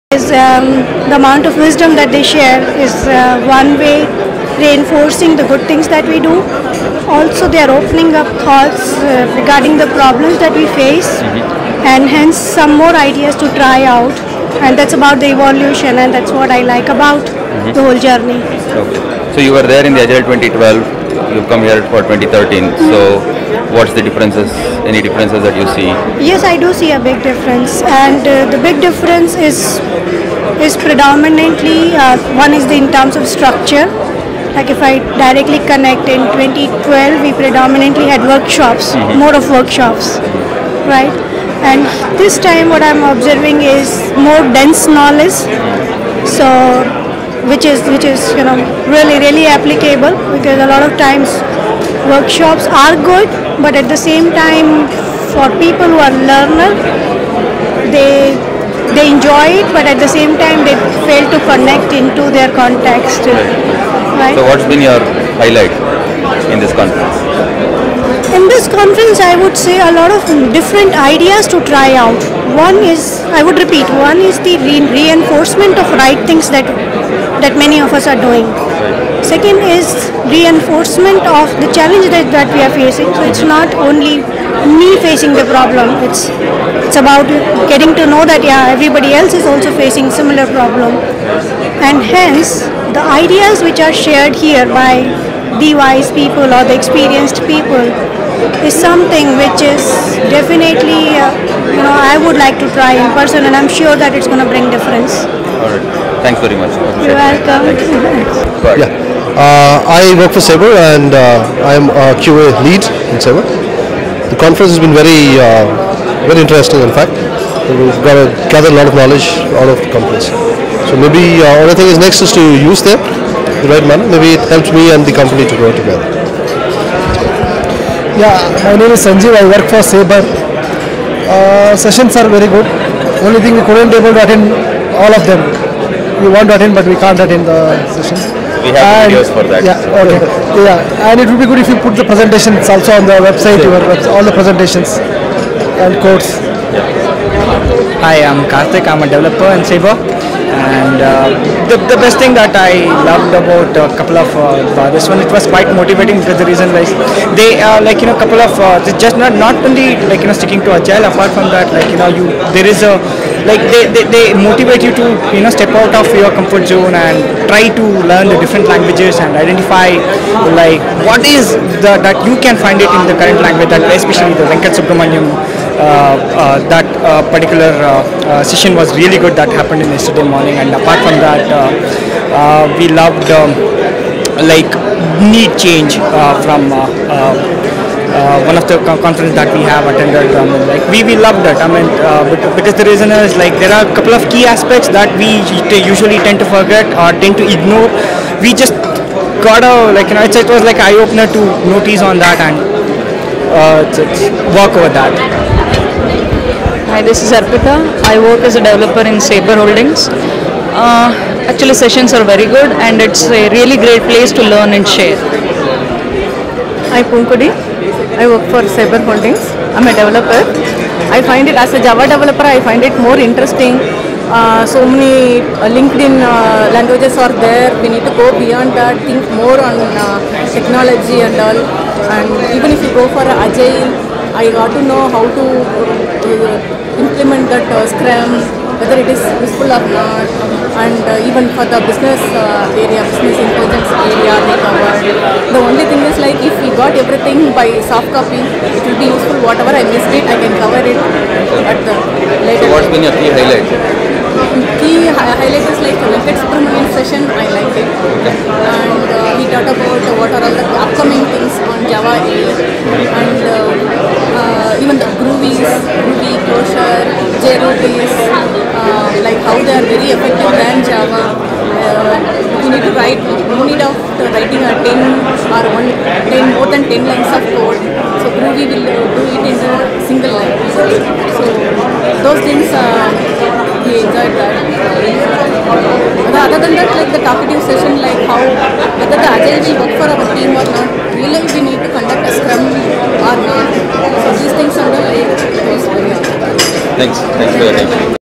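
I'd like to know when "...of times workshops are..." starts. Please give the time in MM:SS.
00:50.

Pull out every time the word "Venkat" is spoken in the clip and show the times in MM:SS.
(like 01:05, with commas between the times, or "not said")
02:54, 04:16.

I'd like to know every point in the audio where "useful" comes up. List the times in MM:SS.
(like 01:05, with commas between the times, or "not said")
03:59, 04:09.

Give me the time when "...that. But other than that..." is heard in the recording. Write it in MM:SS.
04:44.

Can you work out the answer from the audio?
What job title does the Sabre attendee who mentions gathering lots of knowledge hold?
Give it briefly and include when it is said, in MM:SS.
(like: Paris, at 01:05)
QA lead, at 01:52.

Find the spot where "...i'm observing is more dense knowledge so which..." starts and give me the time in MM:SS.
00:42.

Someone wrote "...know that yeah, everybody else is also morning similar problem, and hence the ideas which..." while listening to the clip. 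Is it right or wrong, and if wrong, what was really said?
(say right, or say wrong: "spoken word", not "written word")
wrong: "facing", not "morning".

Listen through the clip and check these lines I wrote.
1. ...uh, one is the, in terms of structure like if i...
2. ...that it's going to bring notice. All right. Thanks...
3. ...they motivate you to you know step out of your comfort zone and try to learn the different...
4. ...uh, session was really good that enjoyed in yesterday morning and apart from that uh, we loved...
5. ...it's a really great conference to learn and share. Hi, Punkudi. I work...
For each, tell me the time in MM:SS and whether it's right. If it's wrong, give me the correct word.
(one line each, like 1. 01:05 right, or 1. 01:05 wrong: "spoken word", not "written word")
1. 00:32 right
2. 01:44 wrong: "difference", not "notice"
3. 02:44 right
4. 02:58 wrong: "happened", not "enjoyed"
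5. 03:33 wrong: "place", not "conference".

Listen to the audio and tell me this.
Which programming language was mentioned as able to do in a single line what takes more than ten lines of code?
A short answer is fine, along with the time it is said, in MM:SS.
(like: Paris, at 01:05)
Groovy, at 04:38.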